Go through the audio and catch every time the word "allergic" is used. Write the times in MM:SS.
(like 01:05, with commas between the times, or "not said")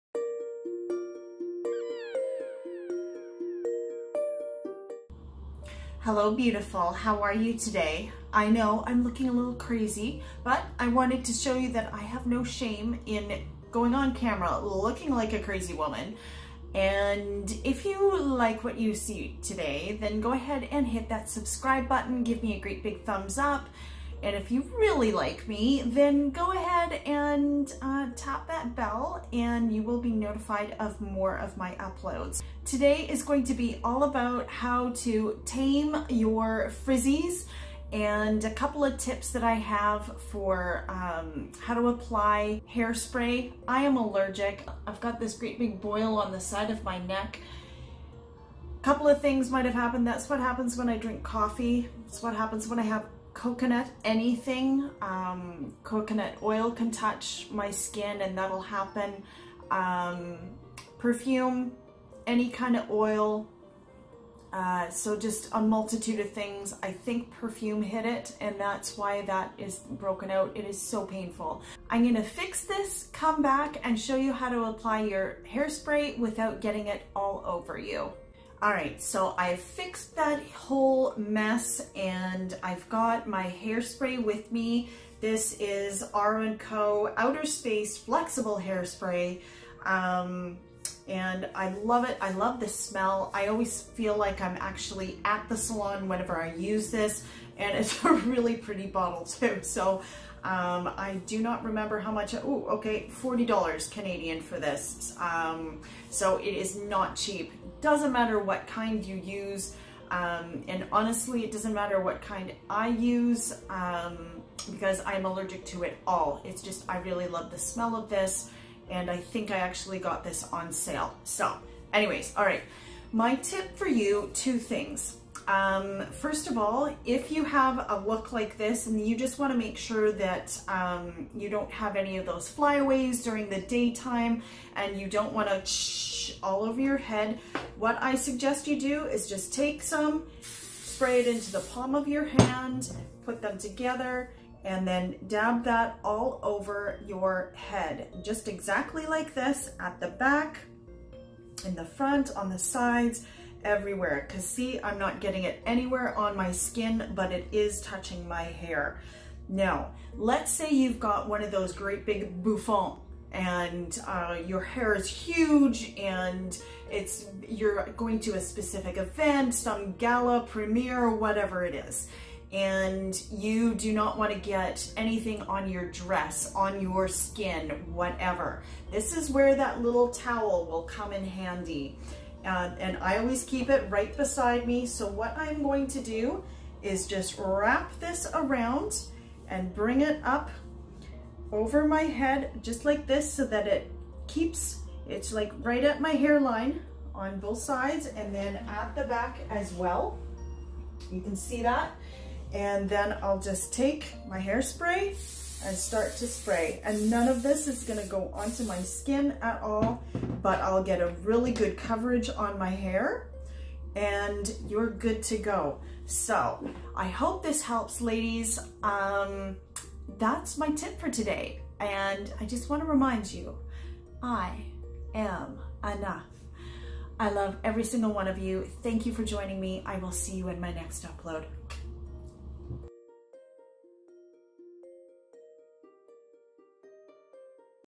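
00:43, 01:55.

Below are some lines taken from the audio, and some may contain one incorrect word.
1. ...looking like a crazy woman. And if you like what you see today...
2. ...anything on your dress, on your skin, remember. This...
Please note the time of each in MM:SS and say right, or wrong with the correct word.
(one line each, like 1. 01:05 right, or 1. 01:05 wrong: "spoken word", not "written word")
1. 00:14 right
2. 02:54 wrong: "whatever", not "remember".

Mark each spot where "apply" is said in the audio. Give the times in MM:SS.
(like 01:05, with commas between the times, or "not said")
00:41, 01:14.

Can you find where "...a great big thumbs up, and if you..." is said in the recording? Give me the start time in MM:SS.
00:22.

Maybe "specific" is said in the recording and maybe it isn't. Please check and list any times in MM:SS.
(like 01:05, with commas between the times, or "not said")
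02:48.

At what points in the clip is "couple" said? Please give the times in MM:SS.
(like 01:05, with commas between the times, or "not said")
00:38, 00:48.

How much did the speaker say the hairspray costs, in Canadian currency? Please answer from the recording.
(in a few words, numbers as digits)
$40.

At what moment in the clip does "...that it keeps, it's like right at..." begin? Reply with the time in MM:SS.
03:13.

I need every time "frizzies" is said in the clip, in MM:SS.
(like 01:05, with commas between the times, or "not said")
00:36.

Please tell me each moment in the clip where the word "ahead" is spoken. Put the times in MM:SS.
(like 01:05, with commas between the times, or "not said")
00:20, 00:26.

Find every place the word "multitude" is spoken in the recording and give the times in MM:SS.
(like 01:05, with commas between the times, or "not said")
01:05.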